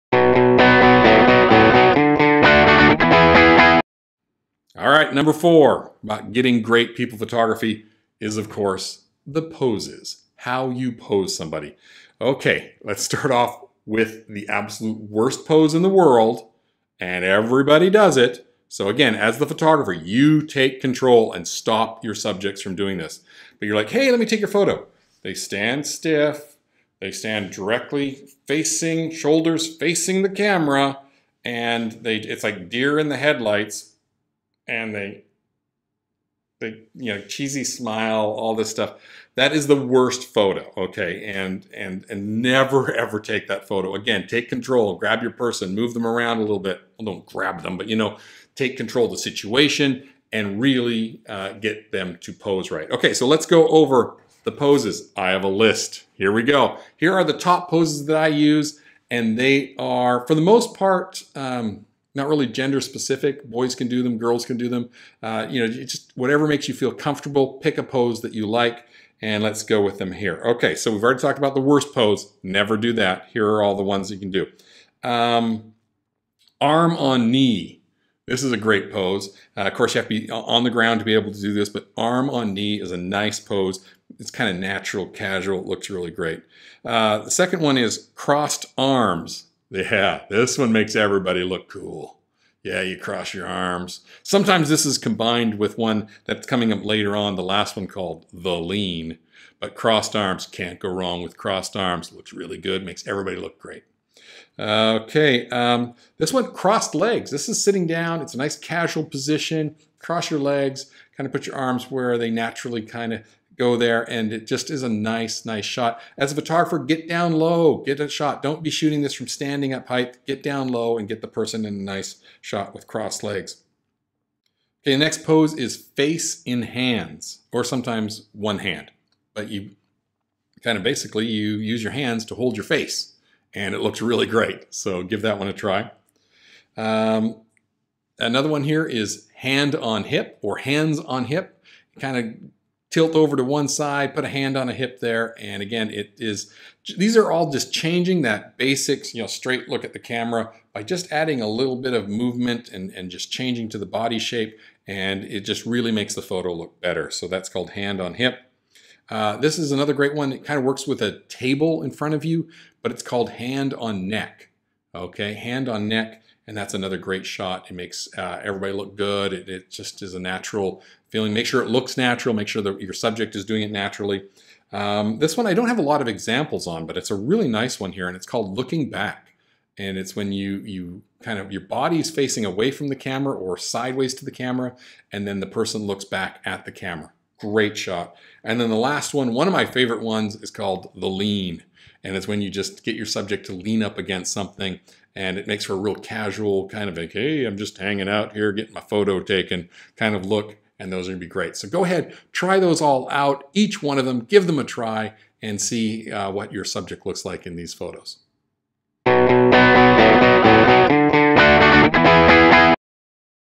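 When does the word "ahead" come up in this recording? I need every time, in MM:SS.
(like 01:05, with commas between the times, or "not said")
03:21.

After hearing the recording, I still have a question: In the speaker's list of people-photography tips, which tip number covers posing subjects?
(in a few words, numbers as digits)
4.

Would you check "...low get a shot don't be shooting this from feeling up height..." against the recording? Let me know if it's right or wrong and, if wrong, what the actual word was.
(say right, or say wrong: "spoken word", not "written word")
wrong: "standing", not "feeling".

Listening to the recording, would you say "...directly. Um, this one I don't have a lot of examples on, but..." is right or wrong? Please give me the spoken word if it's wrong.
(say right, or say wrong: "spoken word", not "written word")
wrong: "naturally", not "directly".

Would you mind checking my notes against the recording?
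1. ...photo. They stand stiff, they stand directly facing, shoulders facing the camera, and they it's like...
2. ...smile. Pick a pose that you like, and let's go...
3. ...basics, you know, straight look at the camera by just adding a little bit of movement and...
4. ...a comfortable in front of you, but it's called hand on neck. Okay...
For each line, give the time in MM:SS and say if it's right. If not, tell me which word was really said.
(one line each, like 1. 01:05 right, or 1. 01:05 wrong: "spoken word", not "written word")
1. 00:24 right
2. 01:06 wrong: "comfortable", not "smile"
3. 02:28 right
4. 02:41 wrong: "table", not "comfortable".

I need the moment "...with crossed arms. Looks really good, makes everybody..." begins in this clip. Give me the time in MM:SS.
01:41.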